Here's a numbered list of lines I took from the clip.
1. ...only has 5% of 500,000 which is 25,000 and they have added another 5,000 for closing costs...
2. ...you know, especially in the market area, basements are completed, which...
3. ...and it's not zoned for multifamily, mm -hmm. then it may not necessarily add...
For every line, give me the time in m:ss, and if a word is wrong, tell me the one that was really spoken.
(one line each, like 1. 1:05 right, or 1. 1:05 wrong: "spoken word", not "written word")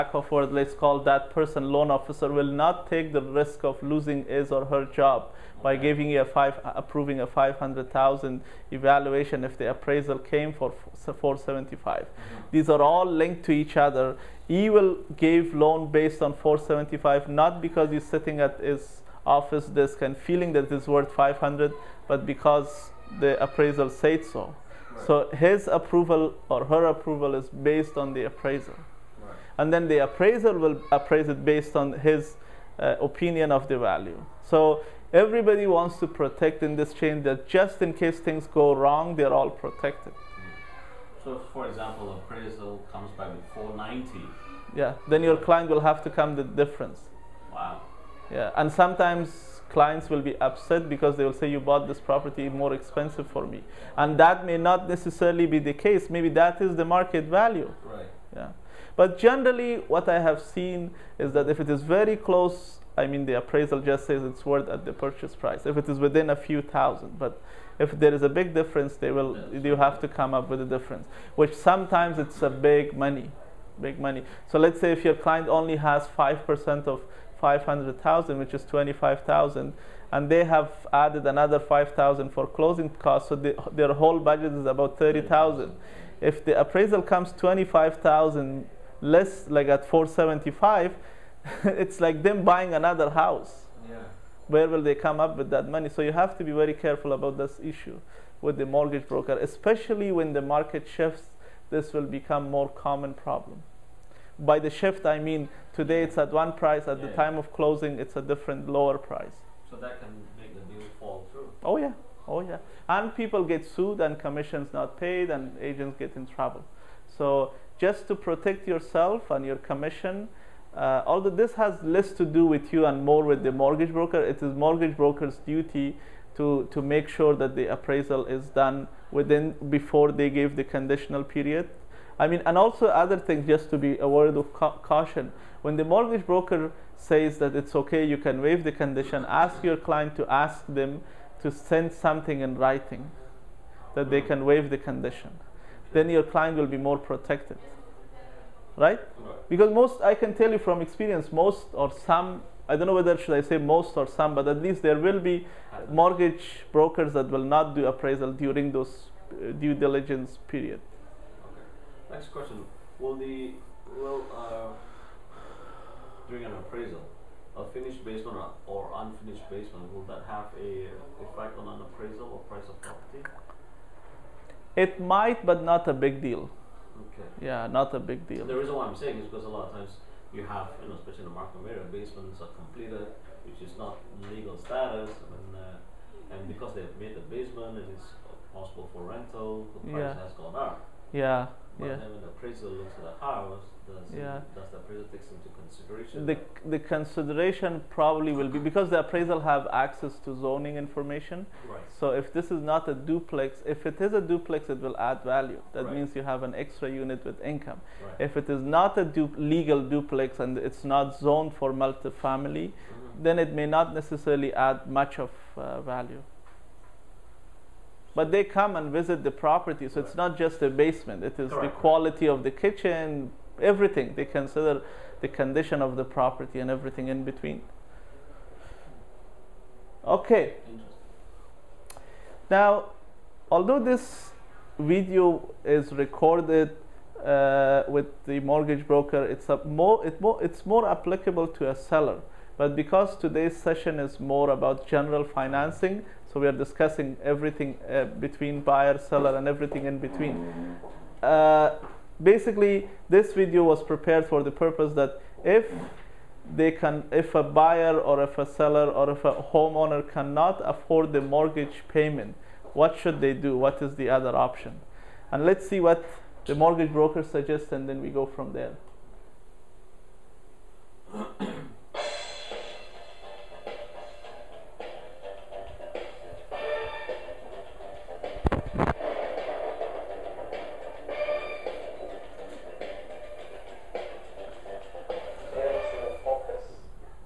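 1. 1:15 right
2. 3:00 right
3. 3:30 right.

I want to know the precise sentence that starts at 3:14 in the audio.
does the appraisal take into consideration?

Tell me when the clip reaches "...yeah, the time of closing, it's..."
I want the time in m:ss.
1:46.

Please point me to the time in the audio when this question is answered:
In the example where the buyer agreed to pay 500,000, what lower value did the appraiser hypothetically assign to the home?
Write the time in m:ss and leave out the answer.
0:11.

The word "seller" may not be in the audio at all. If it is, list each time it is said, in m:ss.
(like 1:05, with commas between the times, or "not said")
4:01, 4:08, 4:18.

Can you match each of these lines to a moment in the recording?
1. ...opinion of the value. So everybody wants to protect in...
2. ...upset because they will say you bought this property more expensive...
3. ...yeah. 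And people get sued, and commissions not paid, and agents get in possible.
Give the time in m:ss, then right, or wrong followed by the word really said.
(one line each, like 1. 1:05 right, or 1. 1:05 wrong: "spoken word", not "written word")
1. 0:33 right
2. 0:50 right
3. 1:52 wrong: "trouble", not "possible".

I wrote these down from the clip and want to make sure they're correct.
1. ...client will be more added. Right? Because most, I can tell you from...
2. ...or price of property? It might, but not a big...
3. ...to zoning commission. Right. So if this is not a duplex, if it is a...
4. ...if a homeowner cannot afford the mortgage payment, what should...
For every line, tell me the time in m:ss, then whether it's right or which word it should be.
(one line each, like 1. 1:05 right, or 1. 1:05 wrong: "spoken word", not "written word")
1. 2:26 wrong: "protected", not "added"
2. 2:52 right
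3. 3:20 wrong: "information", not "commission"
4. 4:19 right.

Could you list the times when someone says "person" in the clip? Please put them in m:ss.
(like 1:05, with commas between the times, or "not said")
0:01.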